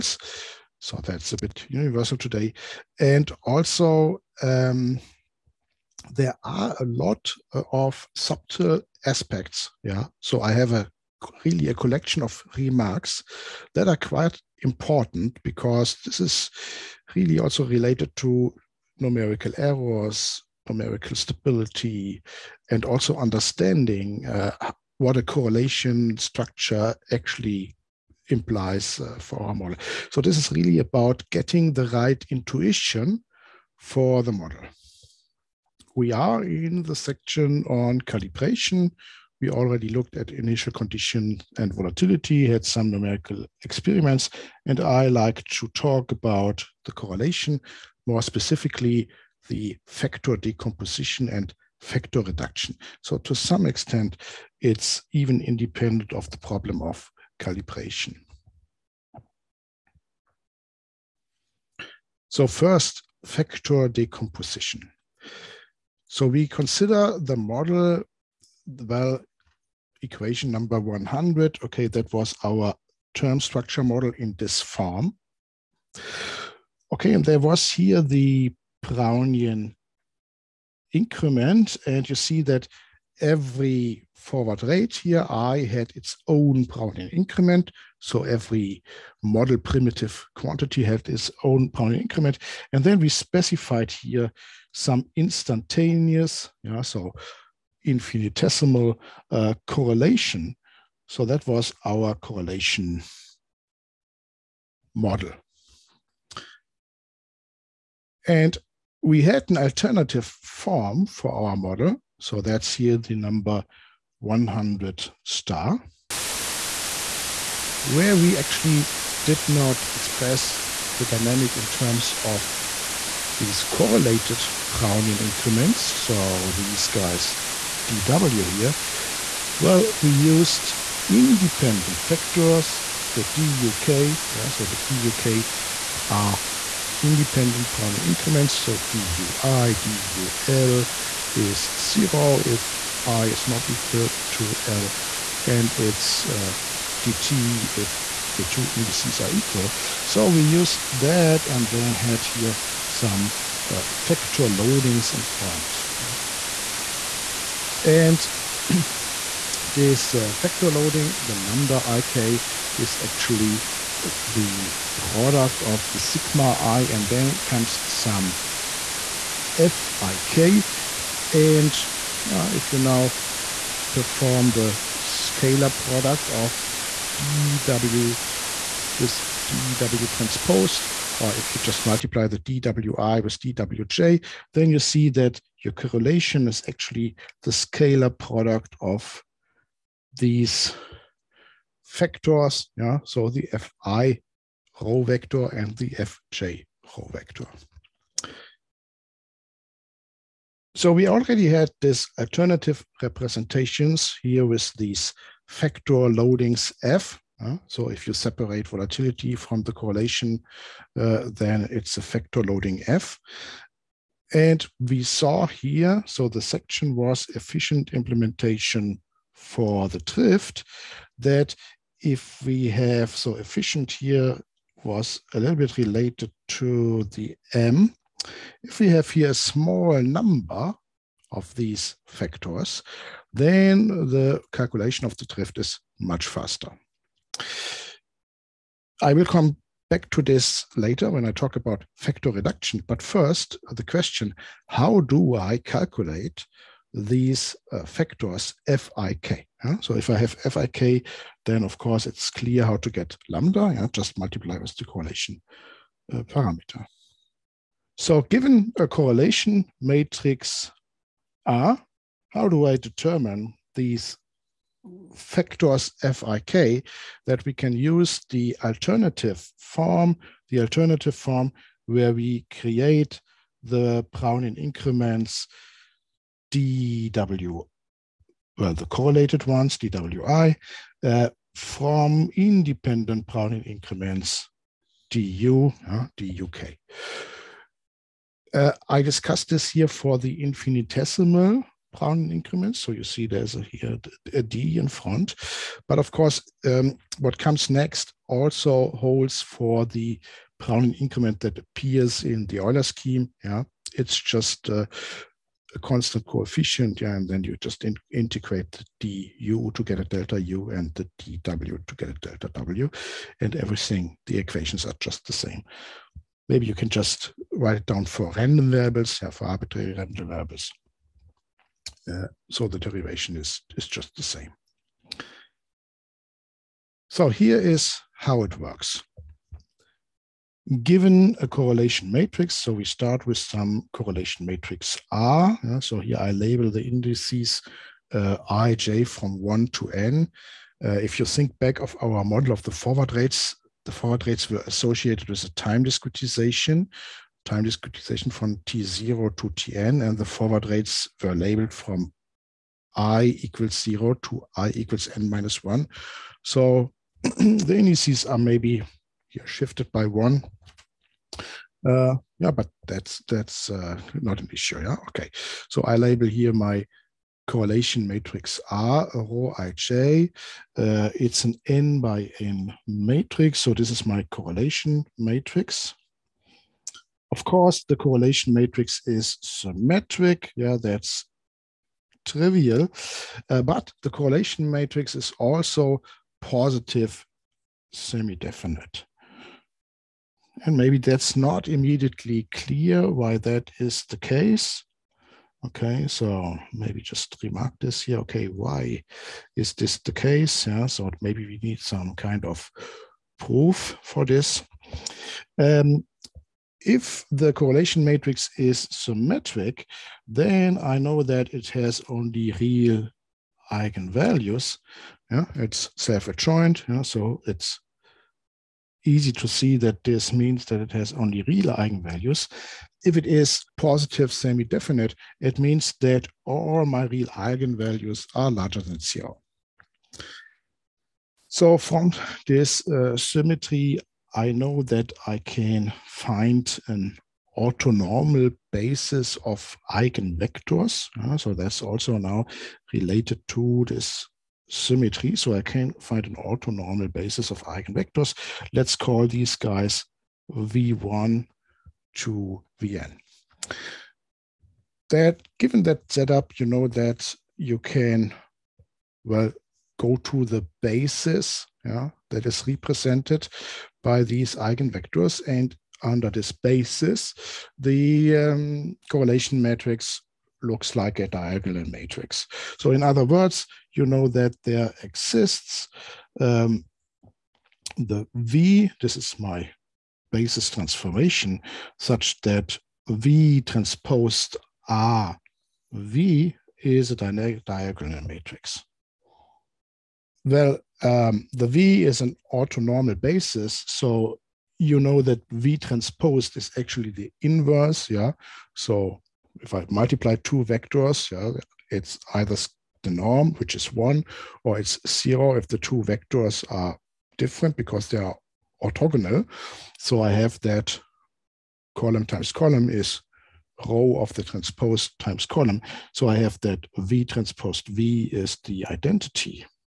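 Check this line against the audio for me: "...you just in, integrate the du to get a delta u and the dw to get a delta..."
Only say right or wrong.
right.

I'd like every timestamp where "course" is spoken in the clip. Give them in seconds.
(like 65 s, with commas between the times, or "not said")
251 s, 296 s, 377 s.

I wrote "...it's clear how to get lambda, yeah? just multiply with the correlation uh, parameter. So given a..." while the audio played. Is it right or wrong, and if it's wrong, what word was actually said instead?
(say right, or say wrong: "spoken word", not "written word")
right.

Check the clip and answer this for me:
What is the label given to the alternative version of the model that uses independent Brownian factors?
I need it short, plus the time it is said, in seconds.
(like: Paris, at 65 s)
100 star, at 114 s.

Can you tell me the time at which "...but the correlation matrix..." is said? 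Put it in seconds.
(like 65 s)
383 s.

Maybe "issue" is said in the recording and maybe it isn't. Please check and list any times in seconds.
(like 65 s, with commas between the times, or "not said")
364 s.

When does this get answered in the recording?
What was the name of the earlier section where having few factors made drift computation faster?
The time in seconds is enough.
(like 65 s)
217 s.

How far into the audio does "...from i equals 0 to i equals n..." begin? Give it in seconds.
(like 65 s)
351 s.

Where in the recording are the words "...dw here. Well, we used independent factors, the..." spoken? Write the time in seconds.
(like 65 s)
127 s.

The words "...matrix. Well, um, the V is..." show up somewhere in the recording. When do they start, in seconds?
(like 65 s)
488 s.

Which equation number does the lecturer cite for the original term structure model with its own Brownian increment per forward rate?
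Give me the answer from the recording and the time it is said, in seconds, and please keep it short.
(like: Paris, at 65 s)
100, at 70 s.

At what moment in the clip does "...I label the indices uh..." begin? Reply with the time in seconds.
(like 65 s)
336 s.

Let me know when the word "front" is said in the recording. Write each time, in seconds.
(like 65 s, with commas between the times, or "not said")
155 s, 294 s.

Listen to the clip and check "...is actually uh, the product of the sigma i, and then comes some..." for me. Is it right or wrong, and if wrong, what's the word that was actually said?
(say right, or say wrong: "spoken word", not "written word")
right.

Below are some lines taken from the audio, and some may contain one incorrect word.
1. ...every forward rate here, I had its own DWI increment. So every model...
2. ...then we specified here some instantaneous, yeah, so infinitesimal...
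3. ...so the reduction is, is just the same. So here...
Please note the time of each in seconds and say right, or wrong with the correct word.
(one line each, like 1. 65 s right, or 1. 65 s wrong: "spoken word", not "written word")
1. 83 s wrong: "Brownian", not "DWI"
2. 92 s right
3. 322 s wrong: "derivation", not "reduction".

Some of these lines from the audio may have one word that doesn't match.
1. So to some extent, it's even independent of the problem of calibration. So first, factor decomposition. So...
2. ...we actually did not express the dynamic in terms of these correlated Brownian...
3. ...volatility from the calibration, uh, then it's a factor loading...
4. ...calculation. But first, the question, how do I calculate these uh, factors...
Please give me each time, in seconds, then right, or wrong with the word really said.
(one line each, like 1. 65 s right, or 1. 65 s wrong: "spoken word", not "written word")
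1. 53 s right
2. 118 s right
3. 208 s wrong: "correlation", not "calibration"
4. 242 s wrong: "reduction", not "calculation".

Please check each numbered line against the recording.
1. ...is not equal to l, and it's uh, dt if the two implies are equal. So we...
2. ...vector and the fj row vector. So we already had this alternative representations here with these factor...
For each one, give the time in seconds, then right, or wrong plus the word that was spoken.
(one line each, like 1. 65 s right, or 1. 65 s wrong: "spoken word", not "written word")
1. 143 s wrong: "indices", not "implies"
2. 195 s right.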